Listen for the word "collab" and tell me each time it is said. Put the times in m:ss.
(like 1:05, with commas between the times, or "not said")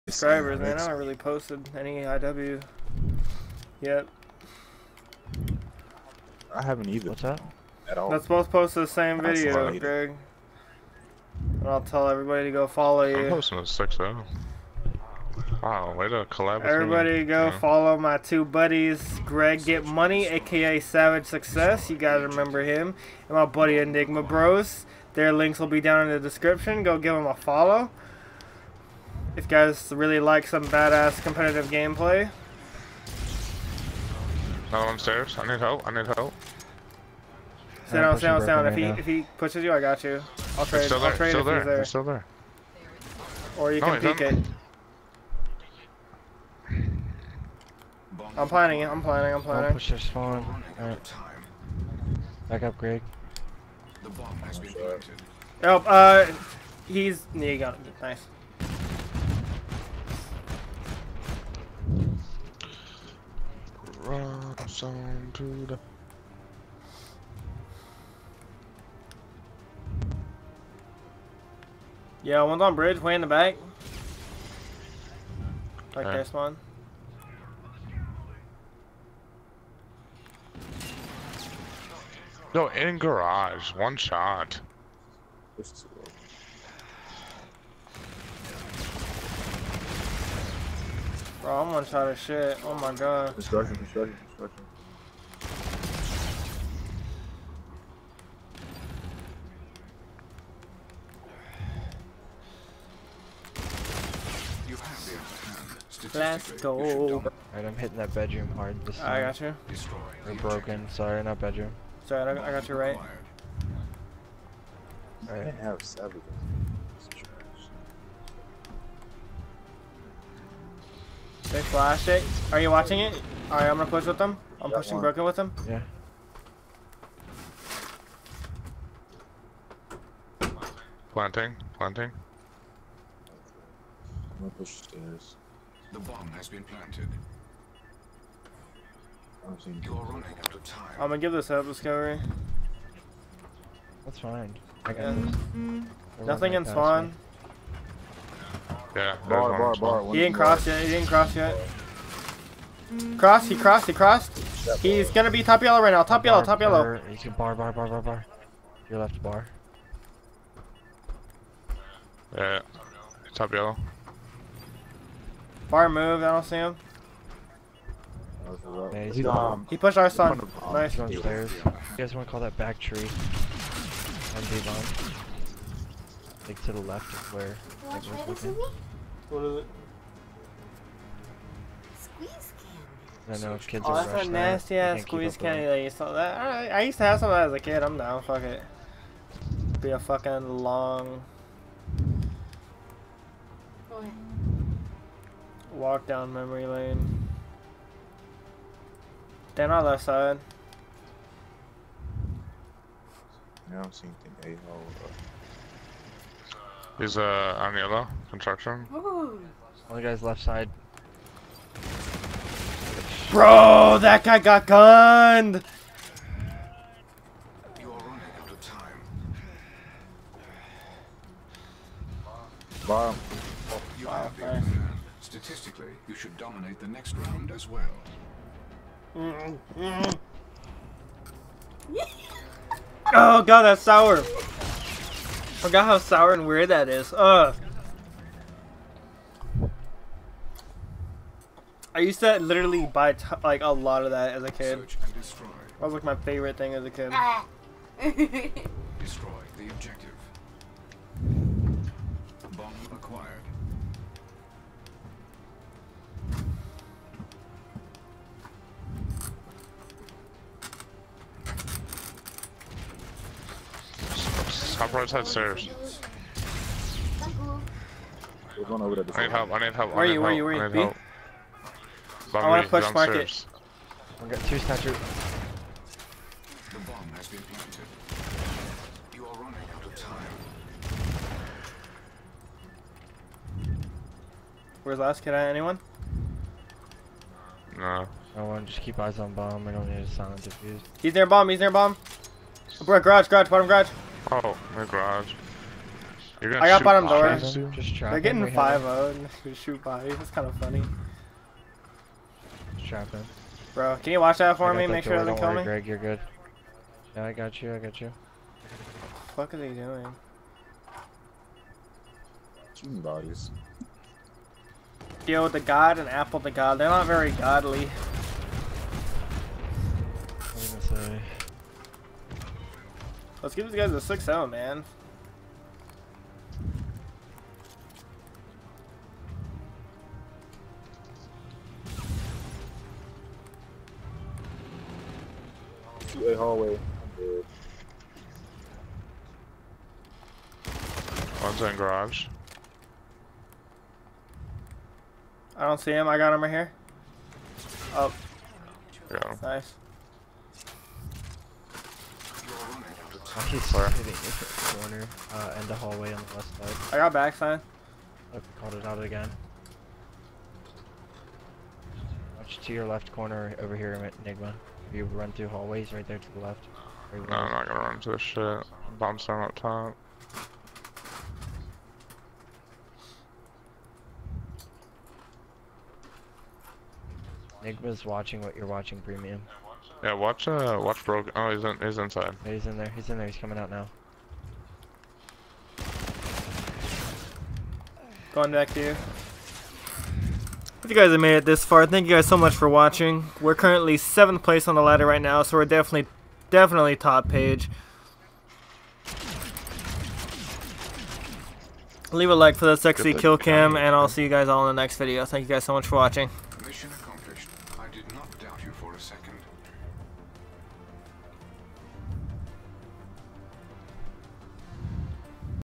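0:16.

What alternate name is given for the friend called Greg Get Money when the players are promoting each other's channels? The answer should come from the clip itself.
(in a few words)
Savage Success.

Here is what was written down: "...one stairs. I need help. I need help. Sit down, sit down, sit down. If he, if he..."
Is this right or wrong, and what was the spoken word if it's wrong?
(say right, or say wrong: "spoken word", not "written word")
wrong: "upstairs", not "stairs".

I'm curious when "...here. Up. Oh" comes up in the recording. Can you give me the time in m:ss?
5:46.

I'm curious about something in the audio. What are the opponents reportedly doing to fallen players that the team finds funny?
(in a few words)
Shooting bodies.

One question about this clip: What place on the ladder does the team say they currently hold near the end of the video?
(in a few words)
7th.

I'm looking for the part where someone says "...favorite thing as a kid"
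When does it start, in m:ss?
4:06.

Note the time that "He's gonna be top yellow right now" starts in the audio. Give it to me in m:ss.
2:34.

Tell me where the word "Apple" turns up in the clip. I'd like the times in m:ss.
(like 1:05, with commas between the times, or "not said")
5:16.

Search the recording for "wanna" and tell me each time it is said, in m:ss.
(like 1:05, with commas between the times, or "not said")
2:52, 4:32.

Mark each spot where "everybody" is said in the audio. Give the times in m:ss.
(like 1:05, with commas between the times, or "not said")
0:12, 0:16.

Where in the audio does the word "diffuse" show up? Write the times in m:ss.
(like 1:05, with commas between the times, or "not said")
4:50.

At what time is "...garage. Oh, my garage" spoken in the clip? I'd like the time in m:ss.
4:53.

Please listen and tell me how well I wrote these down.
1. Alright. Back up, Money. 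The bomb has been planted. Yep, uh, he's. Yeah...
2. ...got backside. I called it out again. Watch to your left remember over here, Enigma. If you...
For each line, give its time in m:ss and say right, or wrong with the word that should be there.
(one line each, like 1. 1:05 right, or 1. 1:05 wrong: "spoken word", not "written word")
1. 0:50 wrong: "Greg", not "Money"
2. 5:56 wrong: "corner", not "remember".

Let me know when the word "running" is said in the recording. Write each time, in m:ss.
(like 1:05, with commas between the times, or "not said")
3:37, 4:39.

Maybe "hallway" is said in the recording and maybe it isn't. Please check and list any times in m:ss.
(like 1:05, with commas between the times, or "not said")
5:36, 5:55, 6:05.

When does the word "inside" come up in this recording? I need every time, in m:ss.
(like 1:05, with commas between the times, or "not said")
6:21.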